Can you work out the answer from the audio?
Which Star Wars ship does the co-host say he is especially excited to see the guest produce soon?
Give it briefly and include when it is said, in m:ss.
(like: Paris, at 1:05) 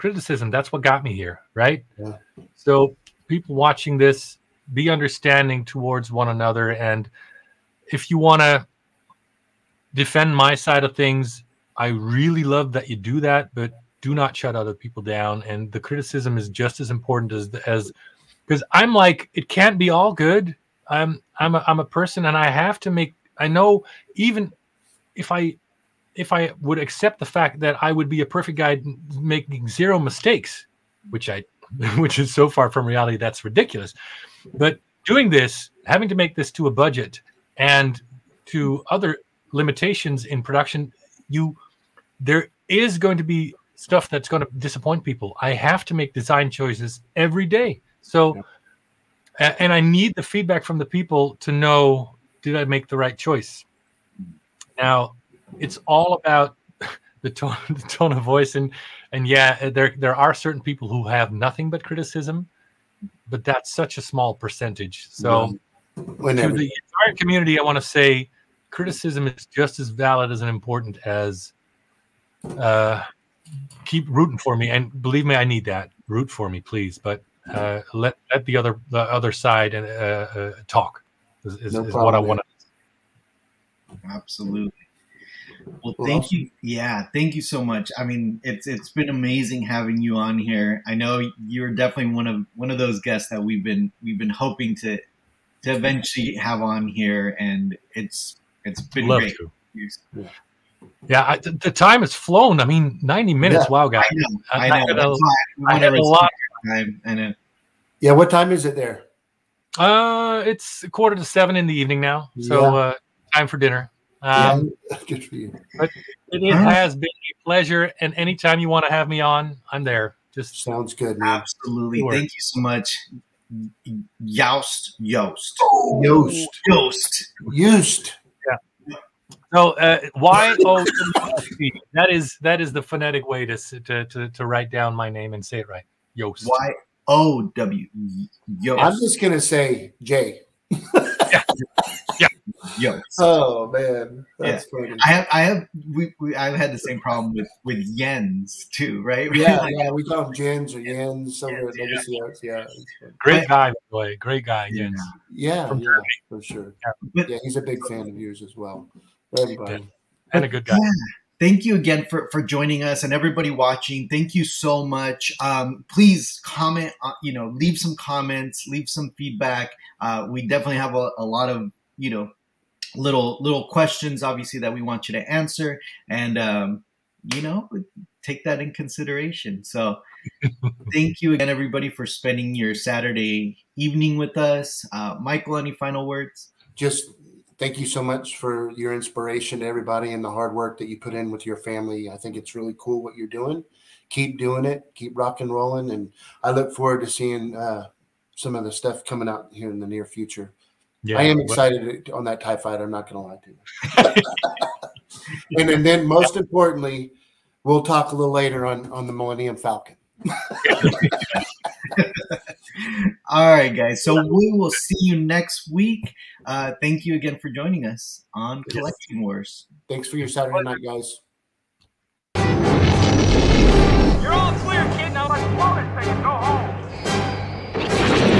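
Tie Fighter, at 3:22.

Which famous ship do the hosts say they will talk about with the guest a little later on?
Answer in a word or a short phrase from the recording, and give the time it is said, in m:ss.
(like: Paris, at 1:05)
Millennium Falcon, at 3:29.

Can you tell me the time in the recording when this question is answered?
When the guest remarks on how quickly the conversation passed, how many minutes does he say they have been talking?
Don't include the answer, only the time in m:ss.
1:43.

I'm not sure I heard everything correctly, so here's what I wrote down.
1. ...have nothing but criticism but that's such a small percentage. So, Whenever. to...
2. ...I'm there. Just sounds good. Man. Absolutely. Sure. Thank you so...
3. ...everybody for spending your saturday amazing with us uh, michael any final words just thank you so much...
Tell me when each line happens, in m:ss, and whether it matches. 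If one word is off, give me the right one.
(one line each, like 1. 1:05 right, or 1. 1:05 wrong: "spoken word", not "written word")
1. 1:01 right
2. 1:59 right
3. 3:01 wrong: "evening", not "amazing".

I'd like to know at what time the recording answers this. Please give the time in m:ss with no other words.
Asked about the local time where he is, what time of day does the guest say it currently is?
1:50.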